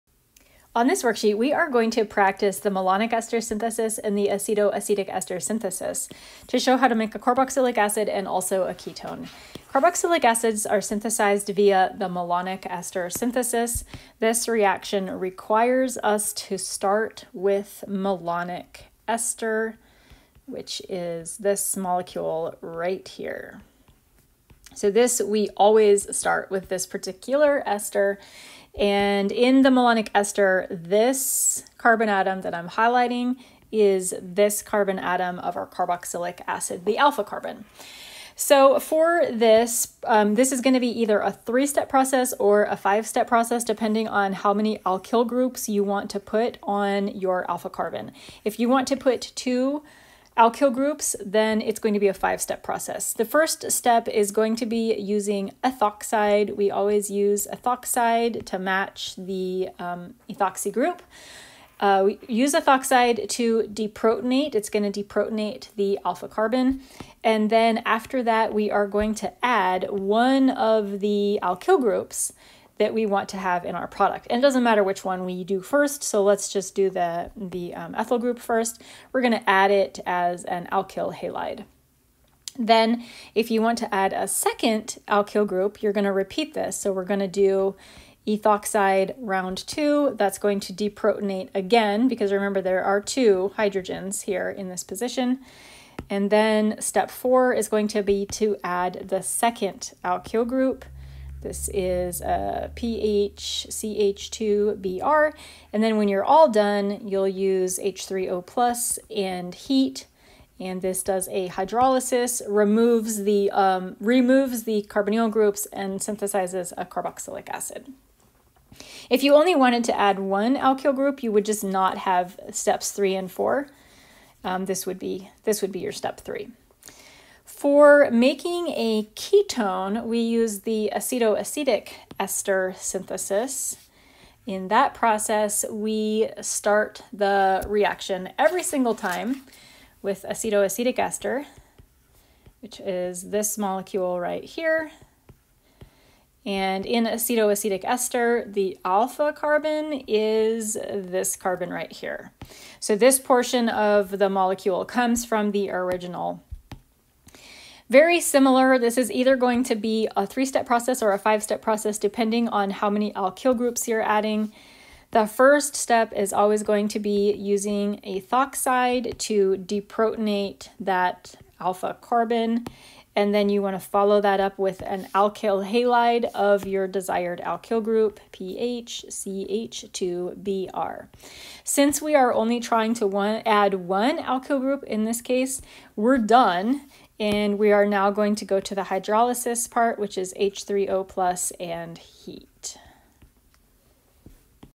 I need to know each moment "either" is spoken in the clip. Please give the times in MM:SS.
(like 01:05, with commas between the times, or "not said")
00:41, 02:39.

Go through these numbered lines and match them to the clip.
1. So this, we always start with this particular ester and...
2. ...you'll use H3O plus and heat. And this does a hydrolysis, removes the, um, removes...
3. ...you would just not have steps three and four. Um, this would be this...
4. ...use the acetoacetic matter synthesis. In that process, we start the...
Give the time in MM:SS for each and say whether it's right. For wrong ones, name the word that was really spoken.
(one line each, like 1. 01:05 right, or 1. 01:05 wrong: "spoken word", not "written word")
1. 00:24 right
2. 01:47 right
3. 02:01 right
4. 02:10 wrong: "ester", not "matter".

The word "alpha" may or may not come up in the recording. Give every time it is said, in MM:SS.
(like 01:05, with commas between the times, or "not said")
00:36, 00:47, 01:06, 02:28, 02:51.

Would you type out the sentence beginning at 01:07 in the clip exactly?
And then after that, we are going to add one of the alkyl groups that we want to have in our product.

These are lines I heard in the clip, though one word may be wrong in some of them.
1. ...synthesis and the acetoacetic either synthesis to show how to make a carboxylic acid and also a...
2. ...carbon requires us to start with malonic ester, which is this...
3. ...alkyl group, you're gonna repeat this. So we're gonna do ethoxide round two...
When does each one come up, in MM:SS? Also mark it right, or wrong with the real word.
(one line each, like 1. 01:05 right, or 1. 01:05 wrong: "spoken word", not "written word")
1. 00:03 wrong: "ester", not "either"
2. 00:14 wrong: "reaction", not "carbon"
3. 01:25 right.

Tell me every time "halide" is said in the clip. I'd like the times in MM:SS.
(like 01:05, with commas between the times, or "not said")
01:21, 02:55.